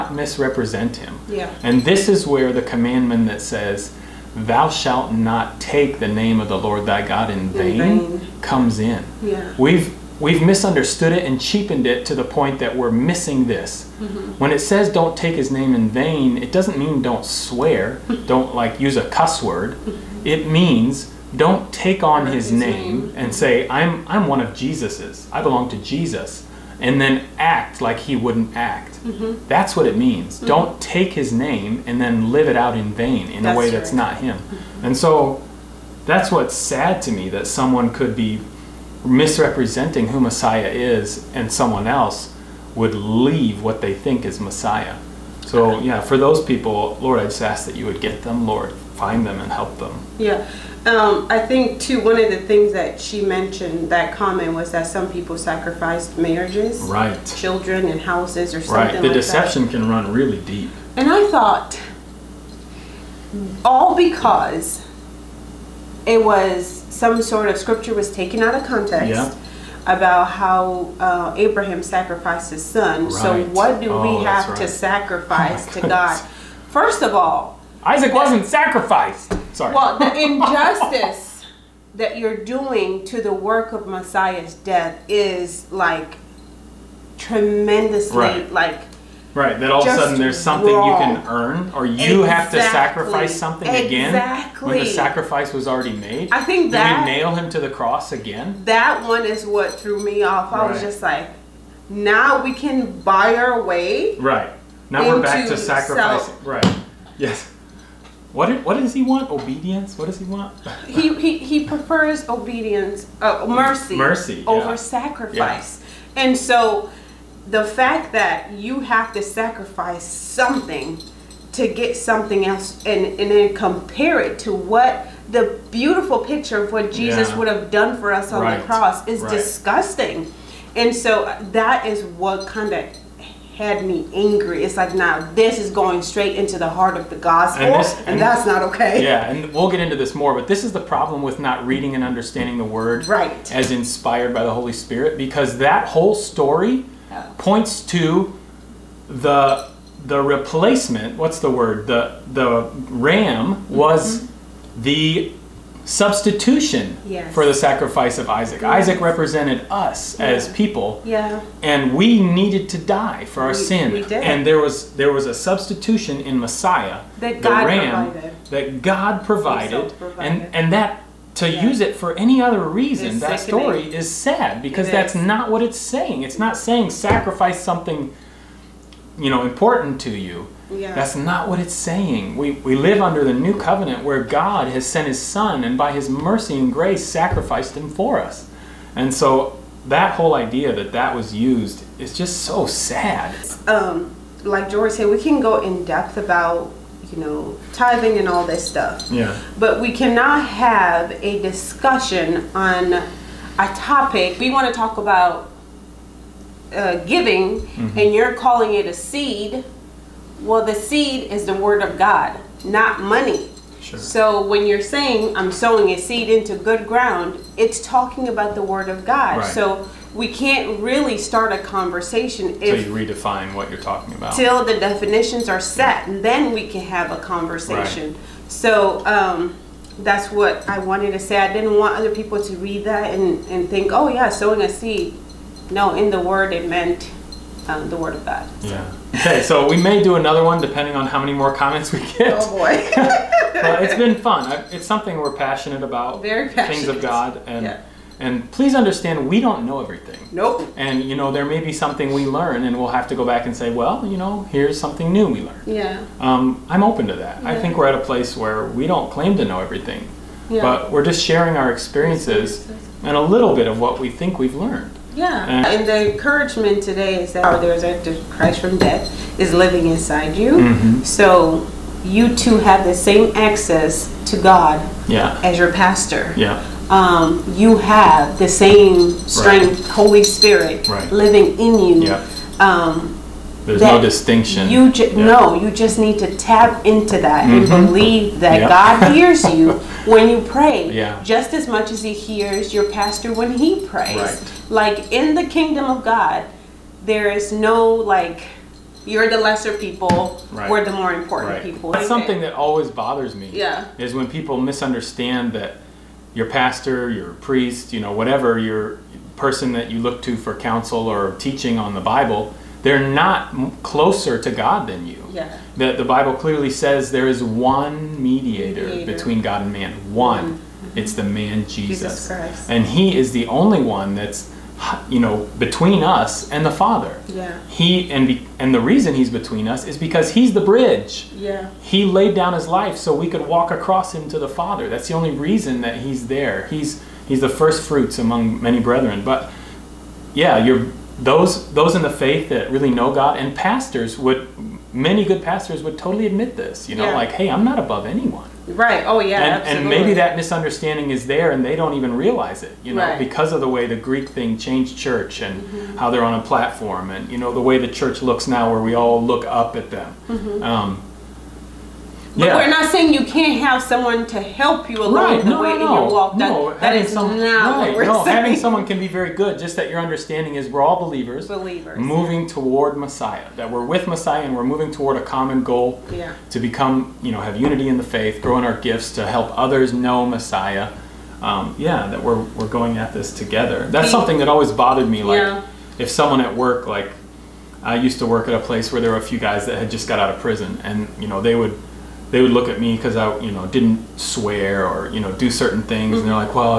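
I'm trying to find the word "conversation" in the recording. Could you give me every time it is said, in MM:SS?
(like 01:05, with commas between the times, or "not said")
03:41, 03:47.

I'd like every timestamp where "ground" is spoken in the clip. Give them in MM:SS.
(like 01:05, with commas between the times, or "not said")
03:36.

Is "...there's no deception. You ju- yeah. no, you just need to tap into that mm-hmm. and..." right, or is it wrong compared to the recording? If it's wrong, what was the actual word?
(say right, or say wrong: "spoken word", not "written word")
wrong: "distinction", not "deception".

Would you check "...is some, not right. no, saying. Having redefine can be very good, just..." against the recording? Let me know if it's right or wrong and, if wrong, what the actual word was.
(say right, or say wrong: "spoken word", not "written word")
wrong: "someone", not "redefine".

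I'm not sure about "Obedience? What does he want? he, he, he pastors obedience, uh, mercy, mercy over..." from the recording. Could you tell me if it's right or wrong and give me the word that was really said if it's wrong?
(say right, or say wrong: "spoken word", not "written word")
wrong: "prefers", not "pastors".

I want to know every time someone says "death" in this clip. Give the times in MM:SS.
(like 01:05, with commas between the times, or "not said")
01:24, 04:28.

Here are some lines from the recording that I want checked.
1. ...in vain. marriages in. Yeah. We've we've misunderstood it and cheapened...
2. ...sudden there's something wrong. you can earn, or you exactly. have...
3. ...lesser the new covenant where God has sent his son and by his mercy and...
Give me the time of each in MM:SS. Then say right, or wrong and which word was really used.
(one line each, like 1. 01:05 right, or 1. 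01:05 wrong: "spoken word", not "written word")
1. 00:07 wrong: "comes", not "marriages"
2. 01:29 right
3. 03:02 wrong: "under", not "lesser".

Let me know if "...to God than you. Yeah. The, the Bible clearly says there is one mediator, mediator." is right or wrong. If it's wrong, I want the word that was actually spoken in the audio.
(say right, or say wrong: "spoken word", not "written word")
right.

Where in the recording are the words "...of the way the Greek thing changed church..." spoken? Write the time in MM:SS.
05:53.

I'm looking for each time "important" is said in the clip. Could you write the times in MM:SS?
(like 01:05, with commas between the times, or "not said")
02:59, 05:01.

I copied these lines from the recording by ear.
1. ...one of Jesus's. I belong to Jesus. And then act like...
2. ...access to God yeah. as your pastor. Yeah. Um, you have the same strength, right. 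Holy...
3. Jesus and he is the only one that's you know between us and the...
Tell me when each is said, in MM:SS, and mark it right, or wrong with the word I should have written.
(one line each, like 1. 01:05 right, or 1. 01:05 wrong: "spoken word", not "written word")
1. 00:24 right
2. 04:33 right
3. 05:22 right.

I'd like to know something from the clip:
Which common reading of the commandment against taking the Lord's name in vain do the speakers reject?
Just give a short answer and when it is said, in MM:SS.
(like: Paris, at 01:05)
Don't swear, at 00:17.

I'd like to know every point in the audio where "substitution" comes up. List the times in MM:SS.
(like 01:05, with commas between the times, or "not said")
02:35, 02:45.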